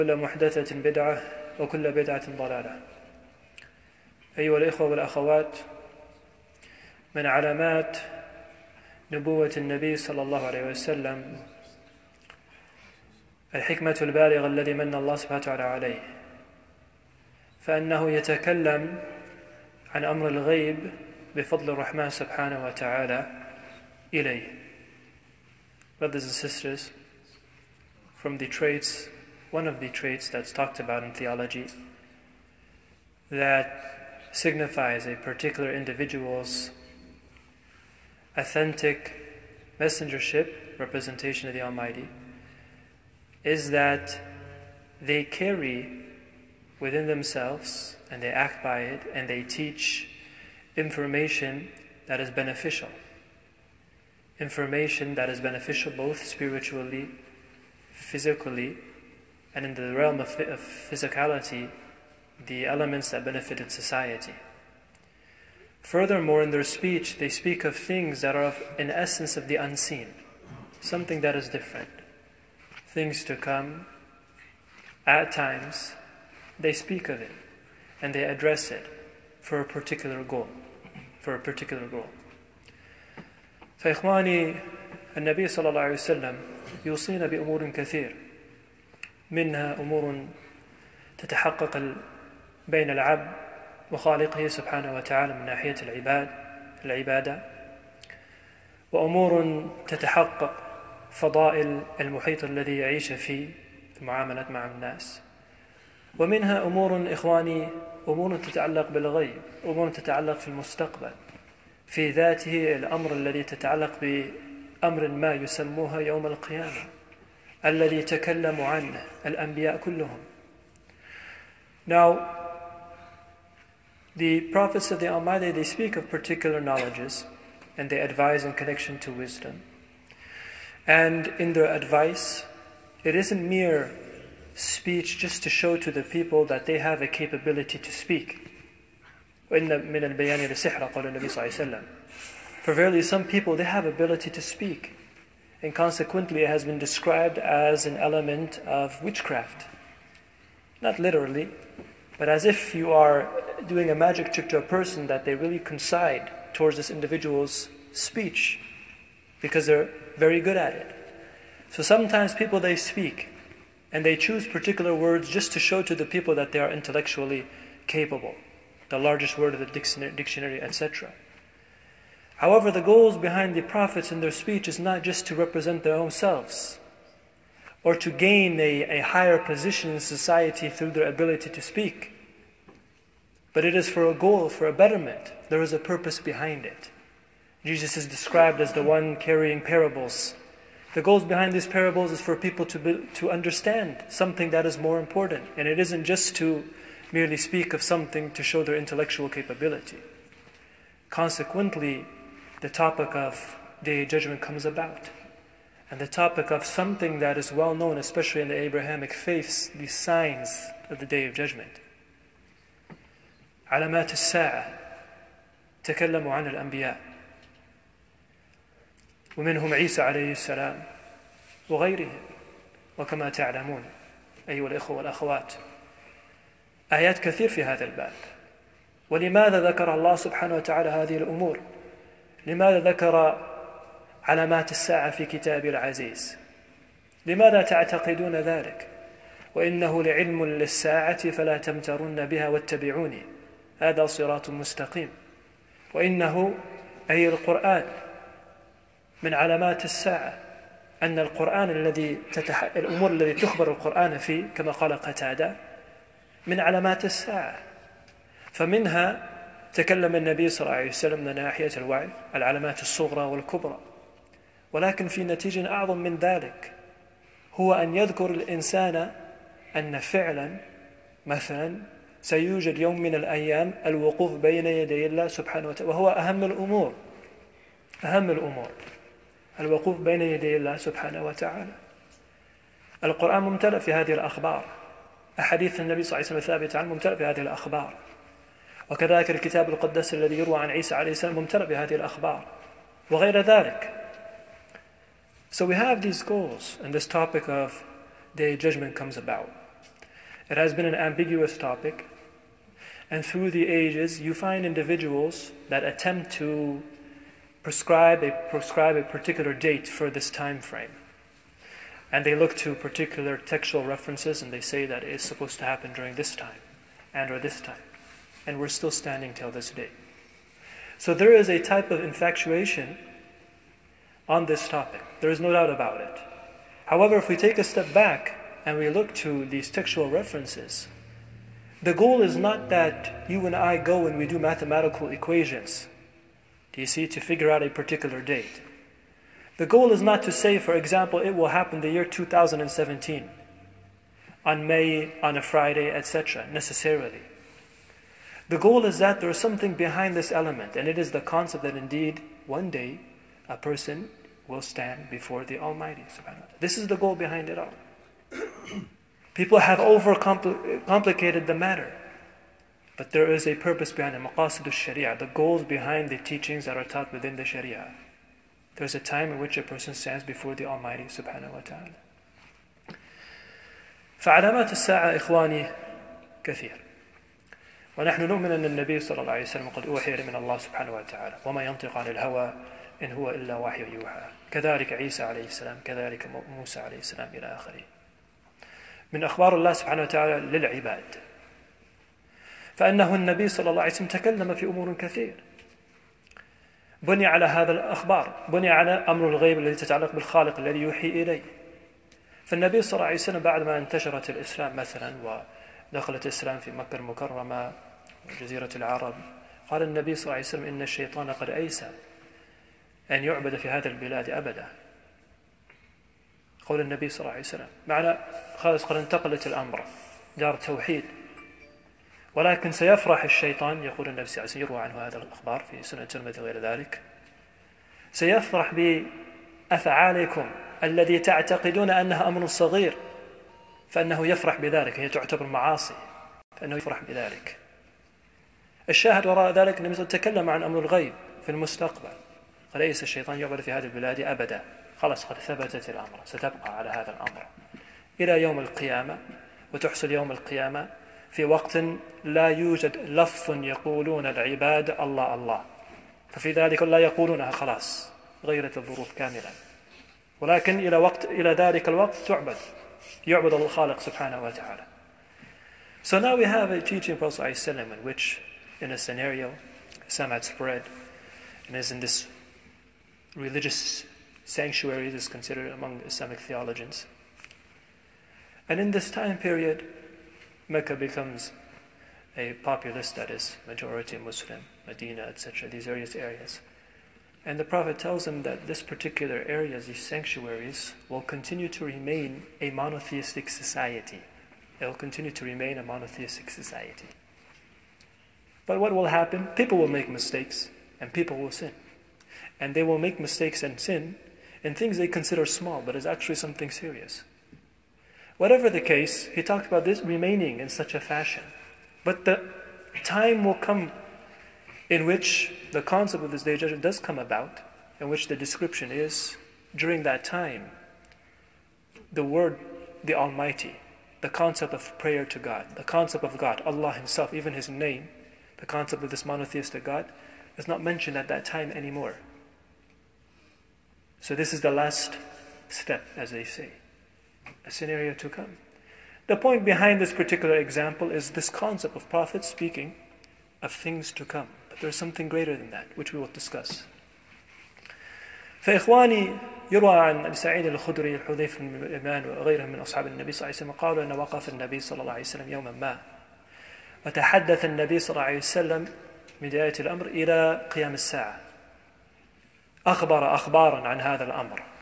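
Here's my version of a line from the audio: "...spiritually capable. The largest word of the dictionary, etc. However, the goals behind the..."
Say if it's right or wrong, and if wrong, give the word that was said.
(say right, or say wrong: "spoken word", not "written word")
wrong: "intellectually", not "spiritually".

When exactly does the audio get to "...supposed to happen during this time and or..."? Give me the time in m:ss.
5:15.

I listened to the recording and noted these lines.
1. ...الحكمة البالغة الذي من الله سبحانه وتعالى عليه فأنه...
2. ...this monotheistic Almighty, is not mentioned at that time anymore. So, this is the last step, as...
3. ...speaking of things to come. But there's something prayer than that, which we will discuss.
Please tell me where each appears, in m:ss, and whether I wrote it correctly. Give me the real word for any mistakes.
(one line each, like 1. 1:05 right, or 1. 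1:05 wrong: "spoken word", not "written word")
1. 0:13 right
2. 8:49 wrong: "God", not "Almighty"
3. 9:02 wrong: "greater", not "prayer".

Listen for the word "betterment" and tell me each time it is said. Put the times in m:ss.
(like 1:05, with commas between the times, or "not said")
3:04.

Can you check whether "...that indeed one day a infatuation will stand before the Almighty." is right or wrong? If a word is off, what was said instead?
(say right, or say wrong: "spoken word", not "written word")
wrong: "person", not "infatuation".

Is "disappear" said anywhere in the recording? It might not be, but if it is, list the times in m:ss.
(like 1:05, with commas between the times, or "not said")
not said.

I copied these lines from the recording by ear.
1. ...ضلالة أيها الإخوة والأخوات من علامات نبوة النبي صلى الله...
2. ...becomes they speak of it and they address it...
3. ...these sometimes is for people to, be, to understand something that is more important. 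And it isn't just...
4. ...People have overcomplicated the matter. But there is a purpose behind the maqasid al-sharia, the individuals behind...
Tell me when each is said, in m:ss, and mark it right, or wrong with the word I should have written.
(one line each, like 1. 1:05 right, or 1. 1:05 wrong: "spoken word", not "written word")
1. 0:02 right
2. 1:15 wrong: "times", not "becomes"
3. 3:11 wrong: "parables", not "sometimes"
4. 5:59 wrong: "goals", not "individuals".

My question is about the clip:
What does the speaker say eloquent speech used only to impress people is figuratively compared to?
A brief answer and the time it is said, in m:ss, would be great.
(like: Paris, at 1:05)
witchcraft, at 2:29.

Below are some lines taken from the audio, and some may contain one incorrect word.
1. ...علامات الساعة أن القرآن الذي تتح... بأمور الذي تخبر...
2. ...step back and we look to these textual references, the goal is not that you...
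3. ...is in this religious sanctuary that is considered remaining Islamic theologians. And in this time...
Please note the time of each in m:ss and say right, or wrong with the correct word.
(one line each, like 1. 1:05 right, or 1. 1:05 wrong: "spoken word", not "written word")
1. 4:09 wrong: "الأمور", not "بأمور"
2. 5:27 right
3. 7:51 wrong: "among", not "remaining".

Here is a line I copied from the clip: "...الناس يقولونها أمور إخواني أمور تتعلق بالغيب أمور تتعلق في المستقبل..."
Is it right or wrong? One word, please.
wrong.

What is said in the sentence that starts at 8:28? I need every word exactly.
Whatever the case, he talked about this remaining in such a fashion.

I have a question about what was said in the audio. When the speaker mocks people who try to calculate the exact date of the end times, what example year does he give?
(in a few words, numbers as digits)
2017.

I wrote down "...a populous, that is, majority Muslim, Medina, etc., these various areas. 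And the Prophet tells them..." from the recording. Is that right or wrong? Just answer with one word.
right.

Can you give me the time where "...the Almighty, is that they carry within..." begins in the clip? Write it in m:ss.
0:41.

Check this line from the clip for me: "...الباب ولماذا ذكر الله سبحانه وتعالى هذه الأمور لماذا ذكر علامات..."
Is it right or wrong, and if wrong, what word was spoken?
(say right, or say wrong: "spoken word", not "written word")
right.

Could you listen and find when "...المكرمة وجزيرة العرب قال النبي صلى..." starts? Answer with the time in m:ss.
6:46.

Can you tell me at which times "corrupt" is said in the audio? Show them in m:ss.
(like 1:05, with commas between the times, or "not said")
not said.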